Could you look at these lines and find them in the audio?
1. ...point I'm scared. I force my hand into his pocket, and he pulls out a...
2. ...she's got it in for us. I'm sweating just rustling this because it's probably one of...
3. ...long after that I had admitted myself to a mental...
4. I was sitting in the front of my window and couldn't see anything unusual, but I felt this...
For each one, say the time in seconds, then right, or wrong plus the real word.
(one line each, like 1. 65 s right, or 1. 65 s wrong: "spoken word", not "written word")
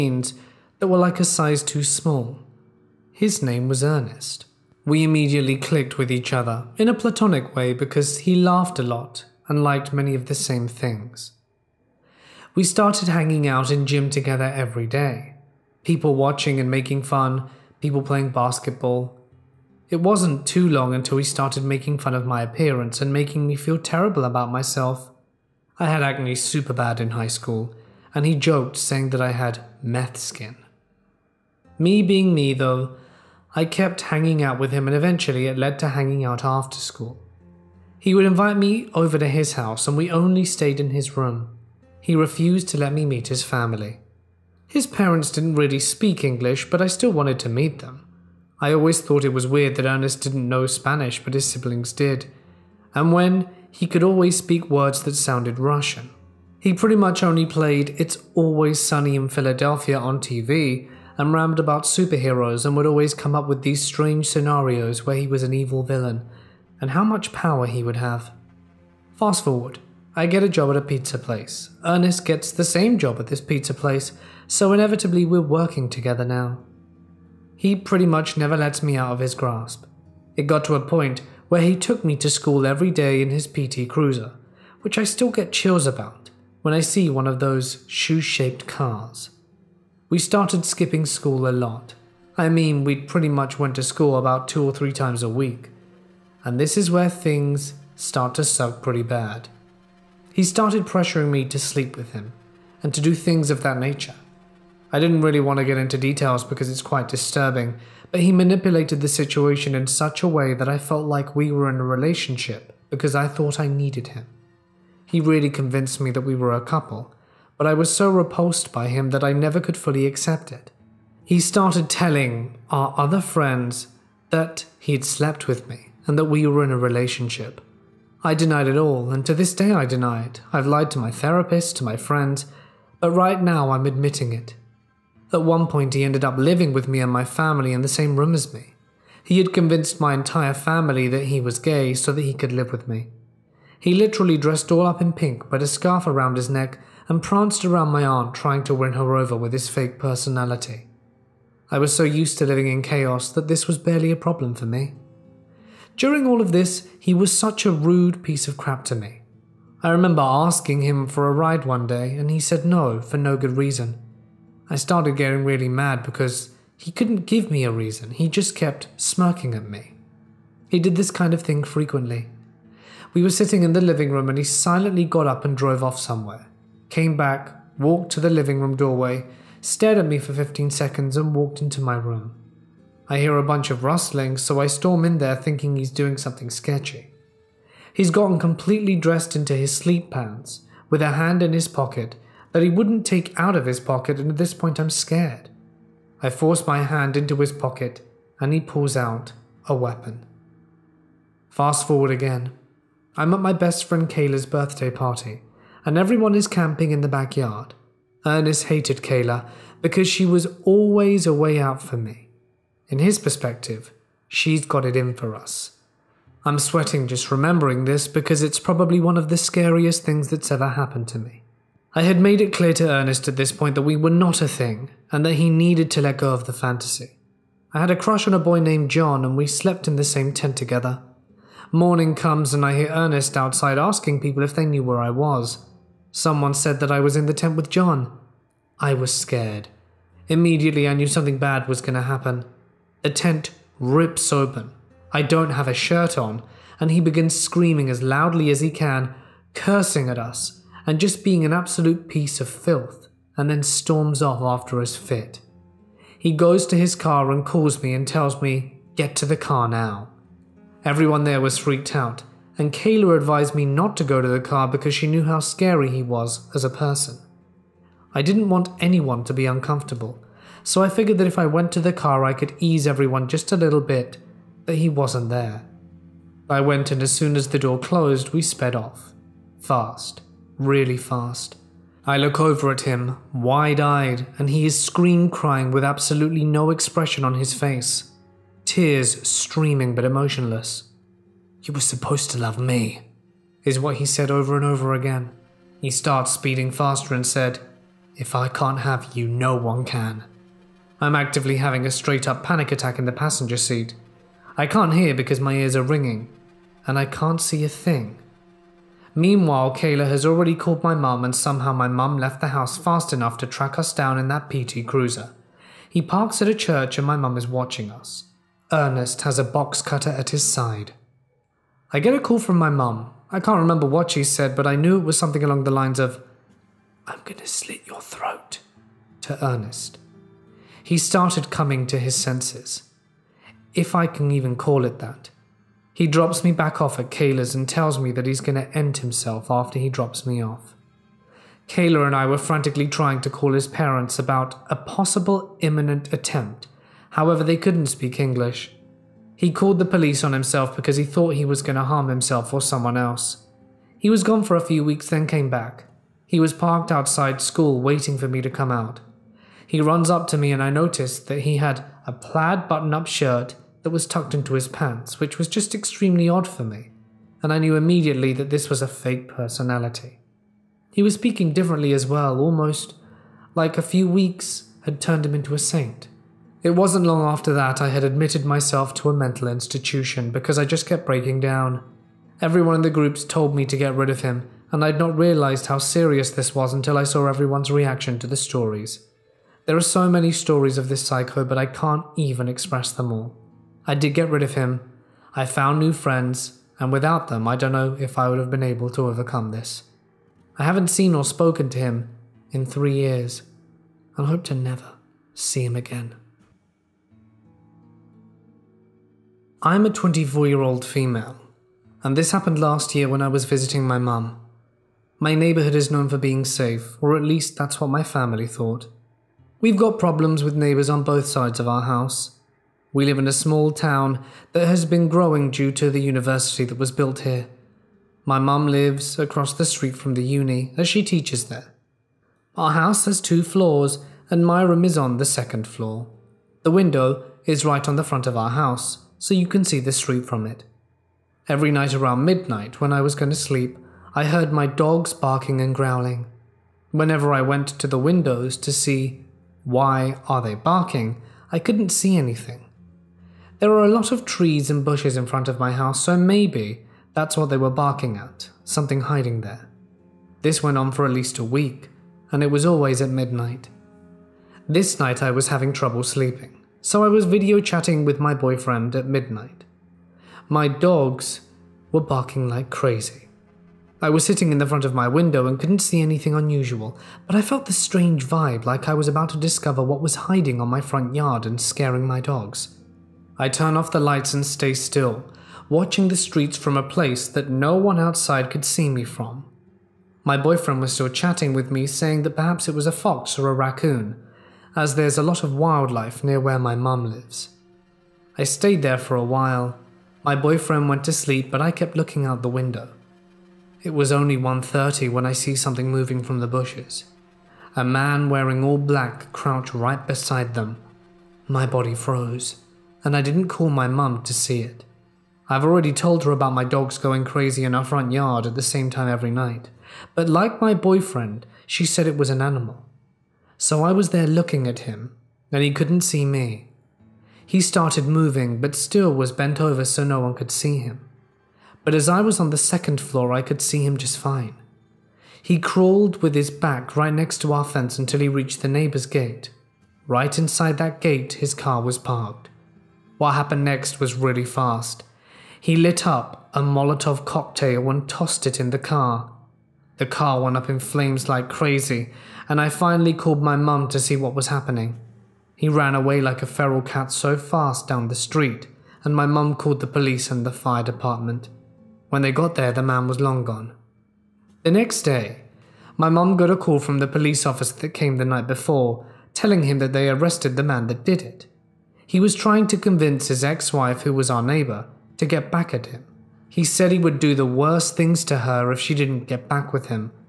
1. 194 s right
2. 214 s wrong: "remembering", not "rustling"
3. 377 s right
4. 474 s right.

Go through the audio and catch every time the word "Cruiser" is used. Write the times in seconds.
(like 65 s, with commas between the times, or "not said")
83 s, 314 s.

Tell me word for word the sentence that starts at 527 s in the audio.
He started moving, but still was bent over so no one could see him.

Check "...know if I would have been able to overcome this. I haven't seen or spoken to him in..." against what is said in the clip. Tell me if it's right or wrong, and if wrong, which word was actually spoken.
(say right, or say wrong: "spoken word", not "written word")
right.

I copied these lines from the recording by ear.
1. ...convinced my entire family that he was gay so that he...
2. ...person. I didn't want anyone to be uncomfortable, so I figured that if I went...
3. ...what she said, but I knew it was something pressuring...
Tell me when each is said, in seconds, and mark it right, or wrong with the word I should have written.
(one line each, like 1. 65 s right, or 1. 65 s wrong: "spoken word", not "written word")
1. 139 s right
2. 266 s right
3. 323 s wrong: "along", not "pressuring".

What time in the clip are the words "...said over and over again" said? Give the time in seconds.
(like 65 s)
294 s.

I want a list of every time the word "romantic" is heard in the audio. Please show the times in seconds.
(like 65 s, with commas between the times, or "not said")
not said.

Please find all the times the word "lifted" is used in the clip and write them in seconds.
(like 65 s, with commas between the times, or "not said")
not said.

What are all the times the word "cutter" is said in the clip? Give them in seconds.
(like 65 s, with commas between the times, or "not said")
319 s.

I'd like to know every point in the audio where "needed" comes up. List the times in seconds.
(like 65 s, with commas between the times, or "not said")
113 s, 225 s.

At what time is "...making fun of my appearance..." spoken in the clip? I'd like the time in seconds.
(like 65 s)
21 s.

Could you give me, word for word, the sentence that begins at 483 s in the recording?
I turn off the lights and stay still, watching the streets from a place that no one outside could see me from.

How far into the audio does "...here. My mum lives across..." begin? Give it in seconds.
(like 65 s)
427 s.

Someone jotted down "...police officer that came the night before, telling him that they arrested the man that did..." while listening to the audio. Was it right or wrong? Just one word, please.
right.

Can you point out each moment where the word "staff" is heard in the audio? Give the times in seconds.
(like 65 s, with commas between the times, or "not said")
not said.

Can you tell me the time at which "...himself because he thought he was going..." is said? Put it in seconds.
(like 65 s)
350 s.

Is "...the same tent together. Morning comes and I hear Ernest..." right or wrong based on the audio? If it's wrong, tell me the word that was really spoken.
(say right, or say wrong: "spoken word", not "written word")
right.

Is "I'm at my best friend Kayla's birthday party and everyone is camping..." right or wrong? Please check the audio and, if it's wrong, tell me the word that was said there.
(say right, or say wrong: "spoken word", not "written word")
right.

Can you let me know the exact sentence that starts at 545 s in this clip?
He lit up a Molotov cocktail and tossed it in the car.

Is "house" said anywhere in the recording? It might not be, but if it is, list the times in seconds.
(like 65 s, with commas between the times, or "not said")
39 s, 312 s, 421 s, 432 s, 438 s, 455 s.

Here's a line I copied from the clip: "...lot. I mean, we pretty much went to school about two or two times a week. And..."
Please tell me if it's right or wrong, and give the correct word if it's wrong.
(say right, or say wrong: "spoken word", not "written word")
wrong: "three", not "two".